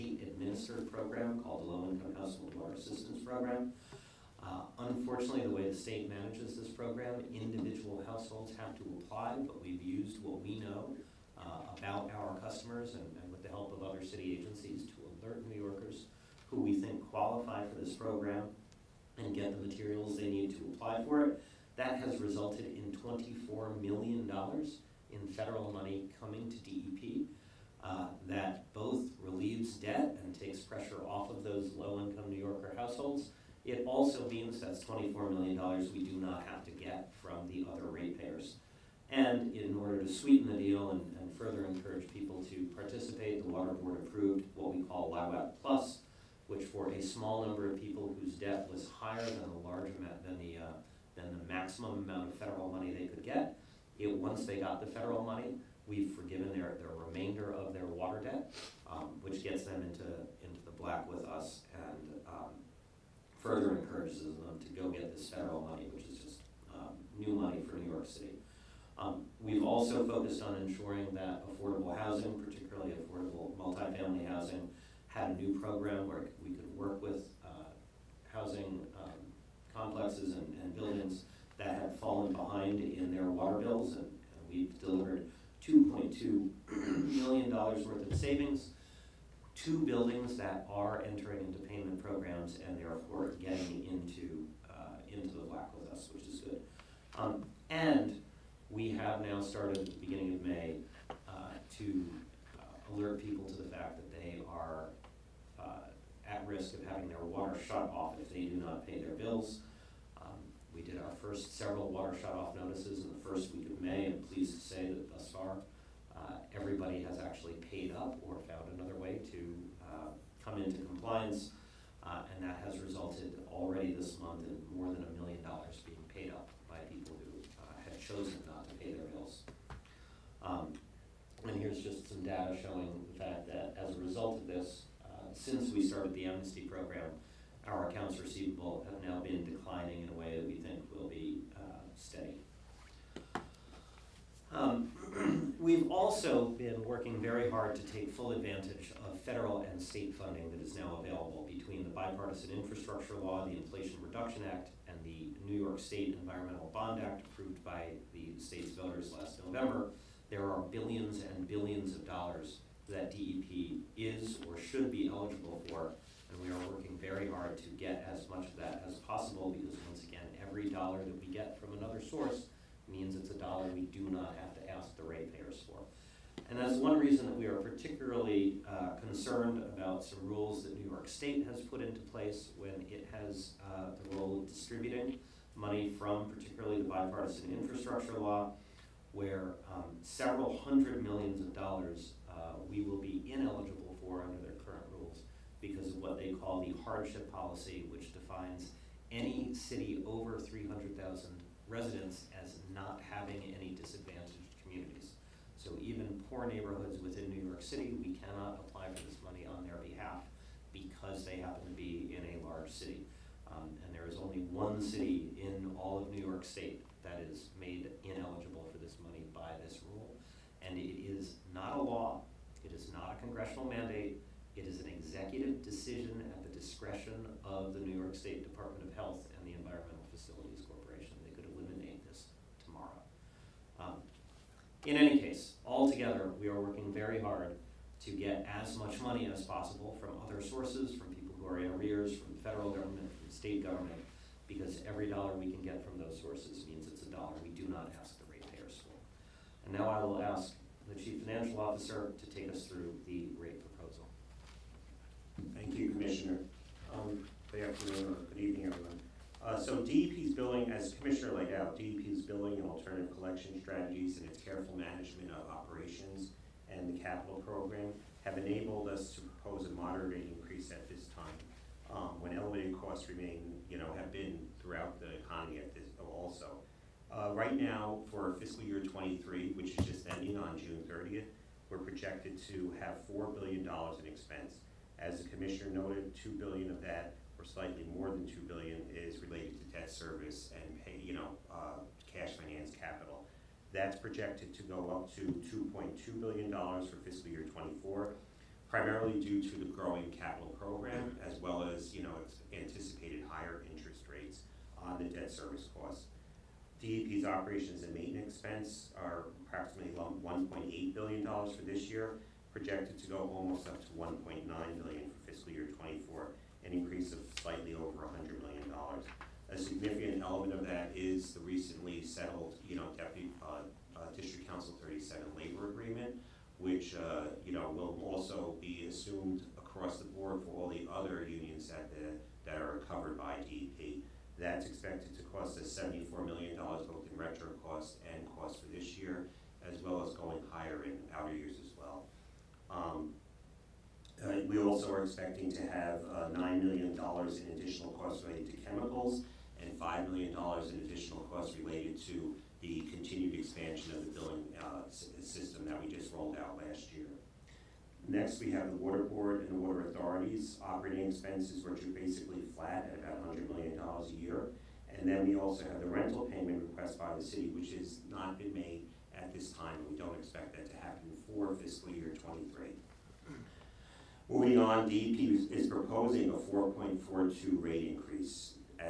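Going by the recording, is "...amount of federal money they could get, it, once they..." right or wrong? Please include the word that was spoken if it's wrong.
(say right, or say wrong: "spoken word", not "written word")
right.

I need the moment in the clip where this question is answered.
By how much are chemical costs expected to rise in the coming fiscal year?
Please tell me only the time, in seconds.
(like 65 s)
346 s.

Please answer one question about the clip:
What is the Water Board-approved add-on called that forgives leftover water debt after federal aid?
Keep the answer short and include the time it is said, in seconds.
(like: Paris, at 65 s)
LIHWAP Plus, at 45 s.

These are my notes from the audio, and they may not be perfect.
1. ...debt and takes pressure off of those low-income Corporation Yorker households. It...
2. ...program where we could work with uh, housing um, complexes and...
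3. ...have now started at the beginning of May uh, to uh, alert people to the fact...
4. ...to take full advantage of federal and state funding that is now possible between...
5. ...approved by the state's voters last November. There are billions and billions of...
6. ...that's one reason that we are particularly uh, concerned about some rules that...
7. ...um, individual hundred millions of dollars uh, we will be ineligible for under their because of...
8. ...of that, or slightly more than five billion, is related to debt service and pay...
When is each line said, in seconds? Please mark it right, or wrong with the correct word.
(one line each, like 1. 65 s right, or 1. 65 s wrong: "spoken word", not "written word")
1. 29 s wrong: "New", not "Corporation"
2. 75 s right
3. 98 s right
4. 147 s wrong: "available", not "possible"
5. 157 s right
6. 176 s right
7. 189 s wrong: "several", not "individual"
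8. 286 s wrong: "two", not "five".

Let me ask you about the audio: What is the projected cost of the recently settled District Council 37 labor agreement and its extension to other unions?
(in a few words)
$74 million.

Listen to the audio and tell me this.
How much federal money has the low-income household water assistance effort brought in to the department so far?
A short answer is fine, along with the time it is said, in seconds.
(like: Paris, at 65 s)
$24 million, at 23 s.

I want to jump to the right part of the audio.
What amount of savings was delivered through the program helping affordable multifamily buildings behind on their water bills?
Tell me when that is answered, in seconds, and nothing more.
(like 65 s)
85 s.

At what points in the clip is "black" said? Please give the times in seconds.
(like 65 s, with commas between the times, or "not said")
60 s, 95 s.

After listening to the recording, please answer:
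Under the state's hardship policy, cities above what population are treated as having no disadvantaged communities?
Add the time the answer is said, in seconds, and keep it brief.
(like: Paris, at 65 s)
300,000, at 200 s.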